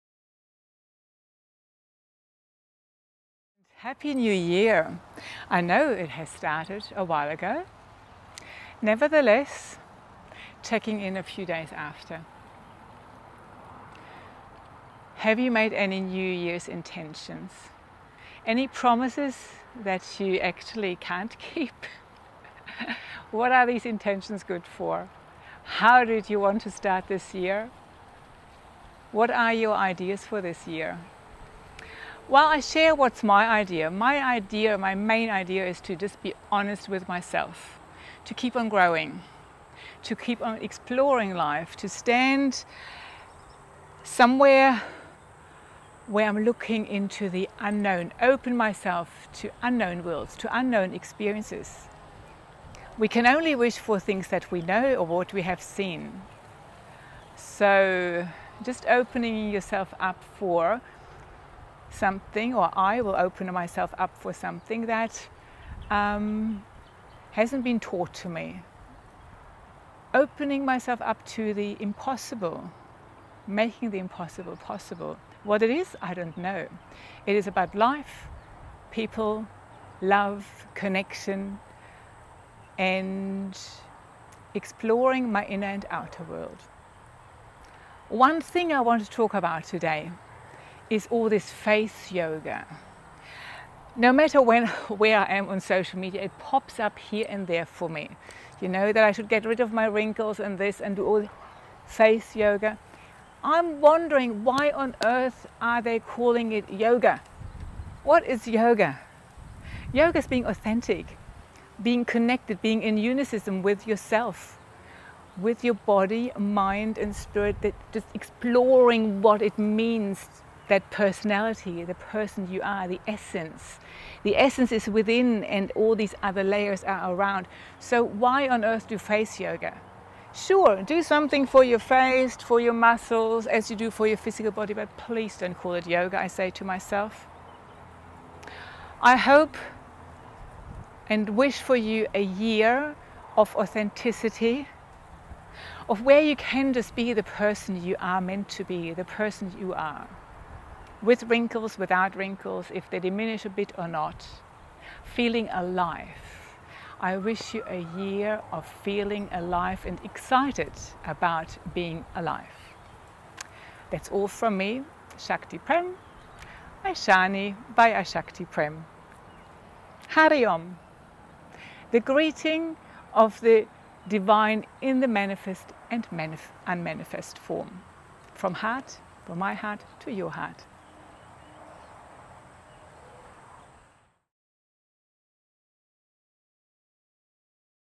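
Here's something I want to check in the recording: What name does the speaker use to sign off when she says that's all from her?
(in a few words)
Shaktiprem.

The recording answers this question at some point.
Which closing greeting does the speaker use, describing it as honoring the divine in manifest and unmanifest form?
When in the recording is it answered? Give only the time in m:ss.
2:50.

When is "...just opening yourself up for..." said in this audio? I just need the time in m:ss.
0:58.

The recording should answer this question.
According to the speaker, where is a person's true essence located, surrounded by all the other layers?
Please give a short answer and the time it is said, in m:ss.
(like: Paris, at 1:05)
Within, at 2:04.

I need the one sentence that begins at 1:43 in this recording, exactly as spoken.
I'm wondering why on earth are they calling it yoga?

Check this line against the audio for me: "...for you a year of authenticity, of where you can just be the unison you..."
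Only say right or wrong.
wrong.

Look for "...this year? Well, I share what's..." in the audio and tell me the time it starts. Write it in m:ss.
0:30.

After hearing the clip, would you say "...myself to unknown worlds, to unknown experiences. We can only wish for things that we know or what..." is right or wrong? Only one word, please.
right.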